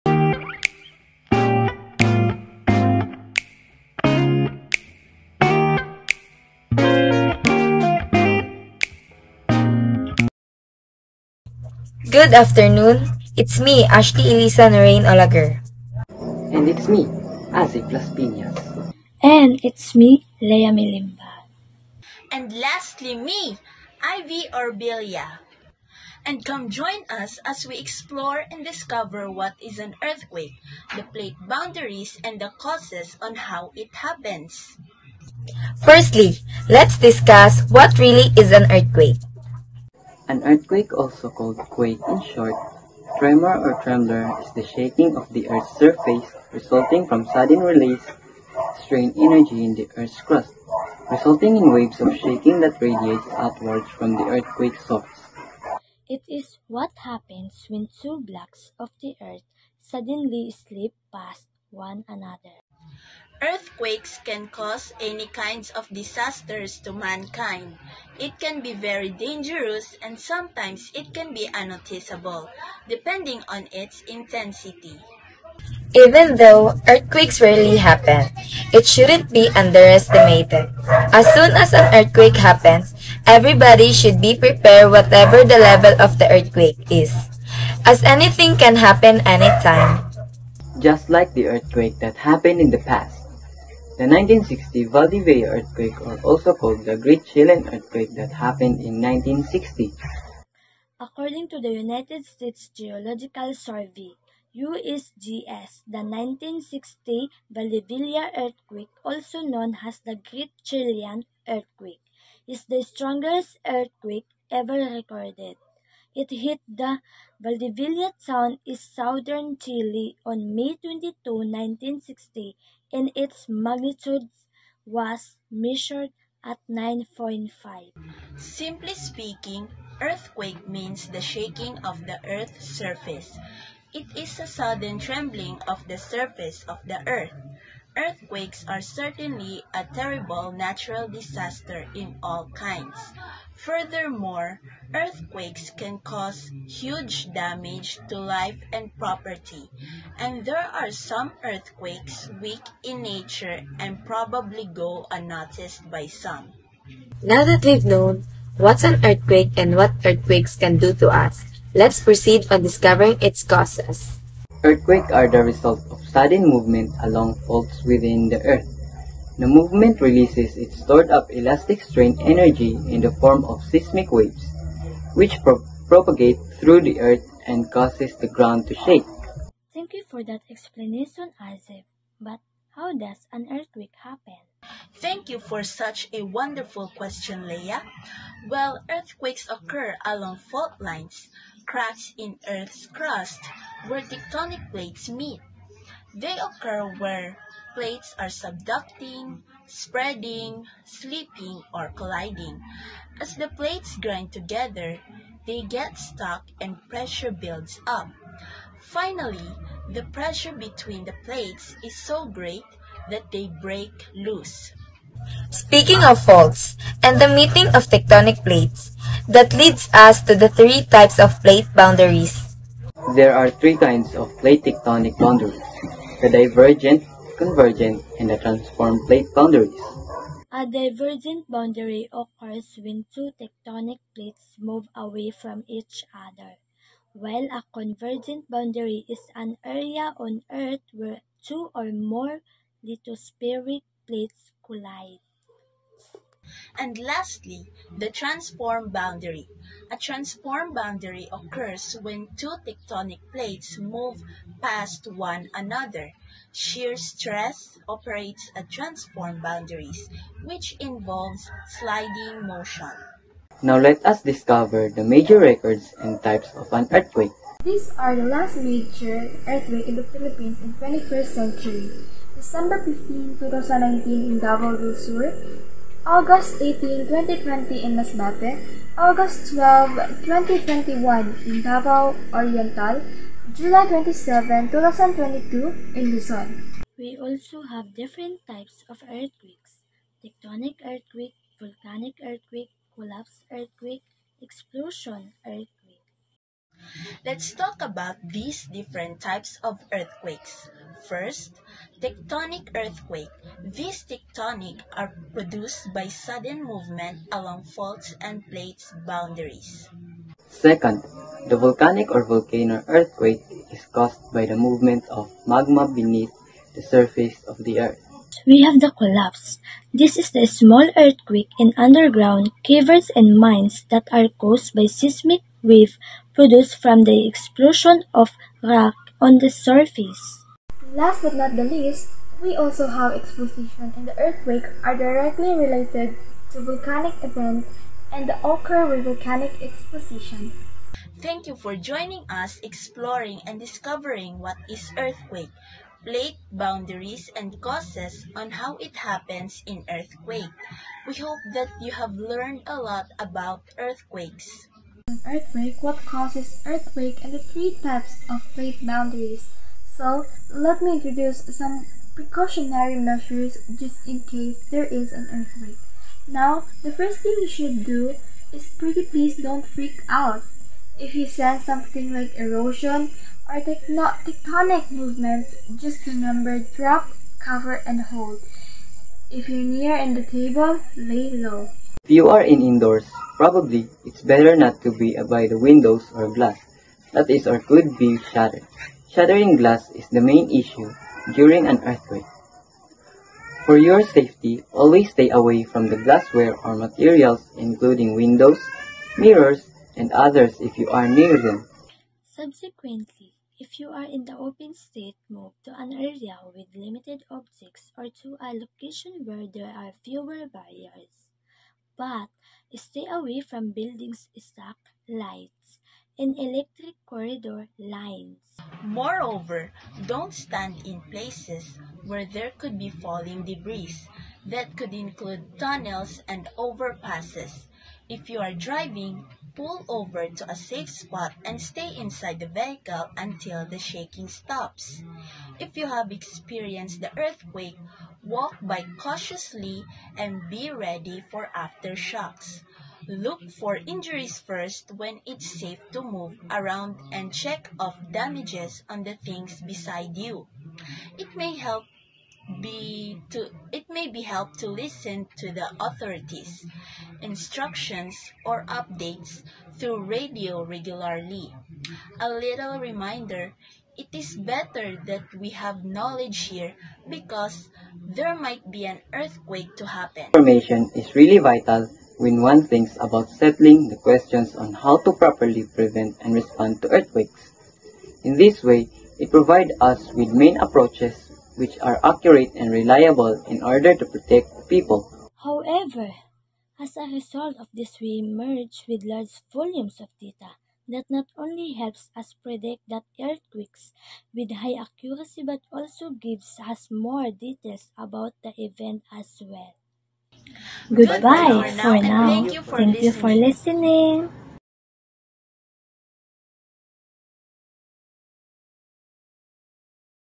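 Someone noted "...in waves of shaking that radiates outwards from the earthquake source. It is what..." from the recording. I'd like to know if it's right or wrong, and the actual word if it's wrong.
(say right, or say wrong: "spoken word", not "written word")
right.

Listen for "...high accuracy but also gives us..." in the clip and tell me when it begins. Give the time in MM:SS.
08:14.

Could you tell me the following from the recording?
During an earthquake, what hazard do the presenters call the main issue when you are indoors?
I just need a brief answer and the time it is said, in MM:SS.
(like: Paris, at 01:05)
Shattering glass, at 06:29.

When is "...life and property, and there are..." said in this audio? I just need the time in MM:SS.
02:28.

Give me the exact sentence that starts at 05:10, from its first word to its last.
Second, the volcanic or volcano earthquake is caused by the movement of magma beneath the surface of the earth.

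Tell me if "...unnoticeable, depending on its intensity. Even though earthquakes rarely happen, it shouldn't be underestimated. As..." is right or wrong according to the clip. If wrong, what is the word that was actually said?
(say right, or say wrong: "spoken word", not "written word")
right.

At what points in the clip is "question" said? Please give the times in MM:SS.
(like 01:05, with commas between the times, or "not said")
03:06, 07:53.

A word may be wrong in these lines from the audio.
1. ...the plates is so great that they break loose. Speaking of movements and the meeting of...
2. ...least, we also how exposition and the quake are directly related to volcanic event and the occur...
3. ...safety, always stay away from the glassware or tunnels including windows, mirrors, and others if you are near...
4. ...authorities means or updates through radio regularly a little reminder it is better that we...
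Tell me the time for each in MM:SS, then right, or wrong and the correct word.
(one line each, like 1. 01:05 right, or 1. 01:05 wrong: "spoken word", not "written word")
1. 03:31 wrong: "faults", not "movements"
2. 05:31 wrong: "earthquake", not "quake"
3. 06:34 wrong: "materials", not "tunnels"
4. 07:35 wrong: "instructions", not "means".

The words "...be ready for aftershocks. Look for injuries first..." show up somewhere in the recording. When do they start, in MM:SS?
07:20.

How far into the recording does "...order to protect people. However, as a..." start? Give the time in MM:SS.
08:03.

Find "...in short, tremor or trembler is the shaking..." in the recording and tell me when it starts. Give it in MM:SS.
00:42.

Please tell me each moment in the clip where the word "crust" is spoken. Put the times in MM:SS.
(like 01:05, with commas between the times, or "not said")
00:50, 03:12.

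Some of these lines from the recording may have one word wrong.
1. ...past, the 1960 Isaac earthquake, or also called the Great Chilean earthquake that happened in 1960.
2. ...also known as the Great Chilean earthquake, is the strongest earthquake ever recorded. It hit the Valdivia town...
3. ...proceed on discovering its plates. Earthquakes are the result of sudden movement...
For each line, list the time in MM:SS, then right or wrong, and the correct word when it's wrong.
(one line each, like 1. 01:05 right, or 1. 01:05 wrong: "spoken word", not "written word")
1. 01:32 wrong: "Valdivia", not "Isaac"
2. 01:49 right
3. 02:42 wrong: "causes", not "plates".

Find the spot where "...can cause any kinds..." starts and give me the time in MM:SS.
01:04.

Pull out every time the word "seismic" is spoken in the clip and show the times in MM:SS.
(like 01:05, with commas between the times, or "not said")
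02:53, 05:24.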